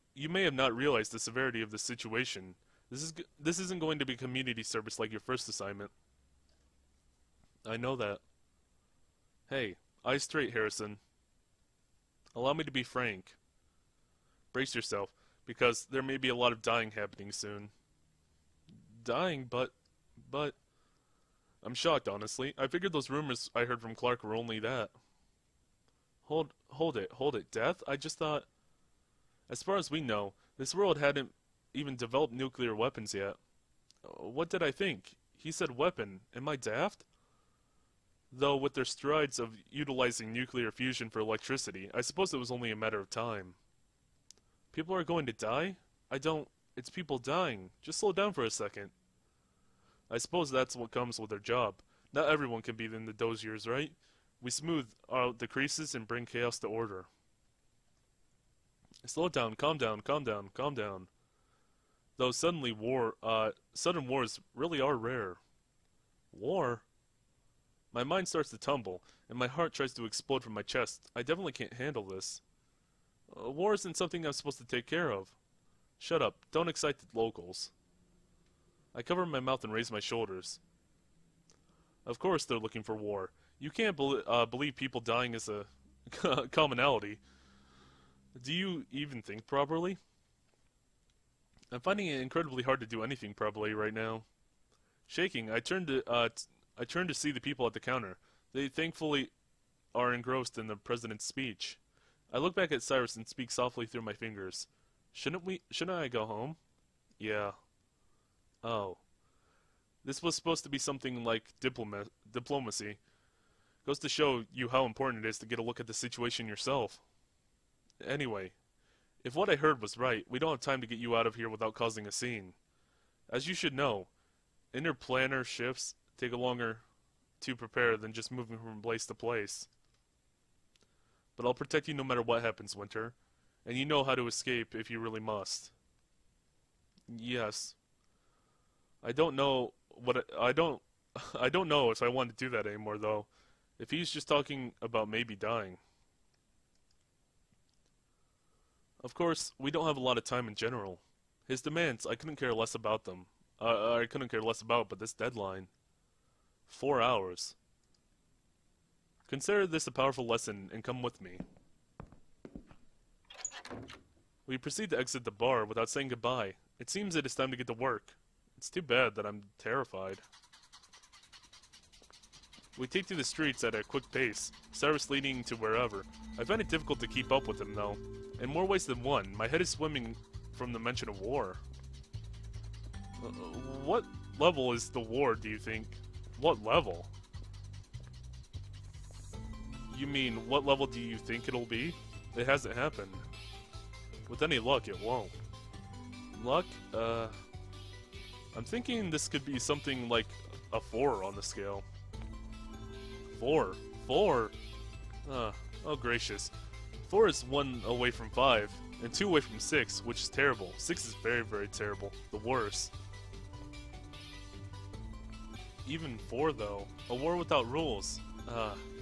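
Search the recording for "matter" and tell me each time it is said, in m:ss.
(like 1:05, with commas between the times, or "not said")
0:42, 2:12.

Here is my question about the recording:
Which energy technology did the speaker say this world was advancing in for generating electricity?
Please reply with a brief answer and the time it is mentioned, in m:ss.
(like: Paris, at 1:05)
nuclear fusion, at 0:40.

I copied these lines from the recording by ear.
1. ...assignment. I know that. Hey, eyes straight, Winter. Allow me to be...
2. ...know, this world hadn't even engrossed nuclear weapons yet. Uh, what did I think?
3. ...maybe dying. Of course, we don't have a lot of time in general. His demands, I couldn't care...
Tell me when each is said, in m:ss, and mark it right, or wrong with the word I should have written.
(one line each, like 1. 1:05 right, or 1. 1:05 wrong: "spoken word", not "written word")
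1. 0:05 wrong: "Harrison", not "Winter"
2. 0:30 wrong: "developed", not "engrossed"
3. 2:25 right.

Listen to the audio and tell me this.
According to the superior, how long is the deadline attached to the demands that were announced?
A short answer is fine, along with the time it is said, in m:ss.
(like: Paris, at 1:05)
4 hours, at 2:36.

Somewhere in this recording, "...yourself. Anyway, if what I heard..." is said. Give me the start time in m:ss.
1:56.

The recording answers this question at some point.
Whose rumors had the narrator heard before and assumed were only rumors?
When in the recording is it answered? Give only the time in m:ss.
0:23.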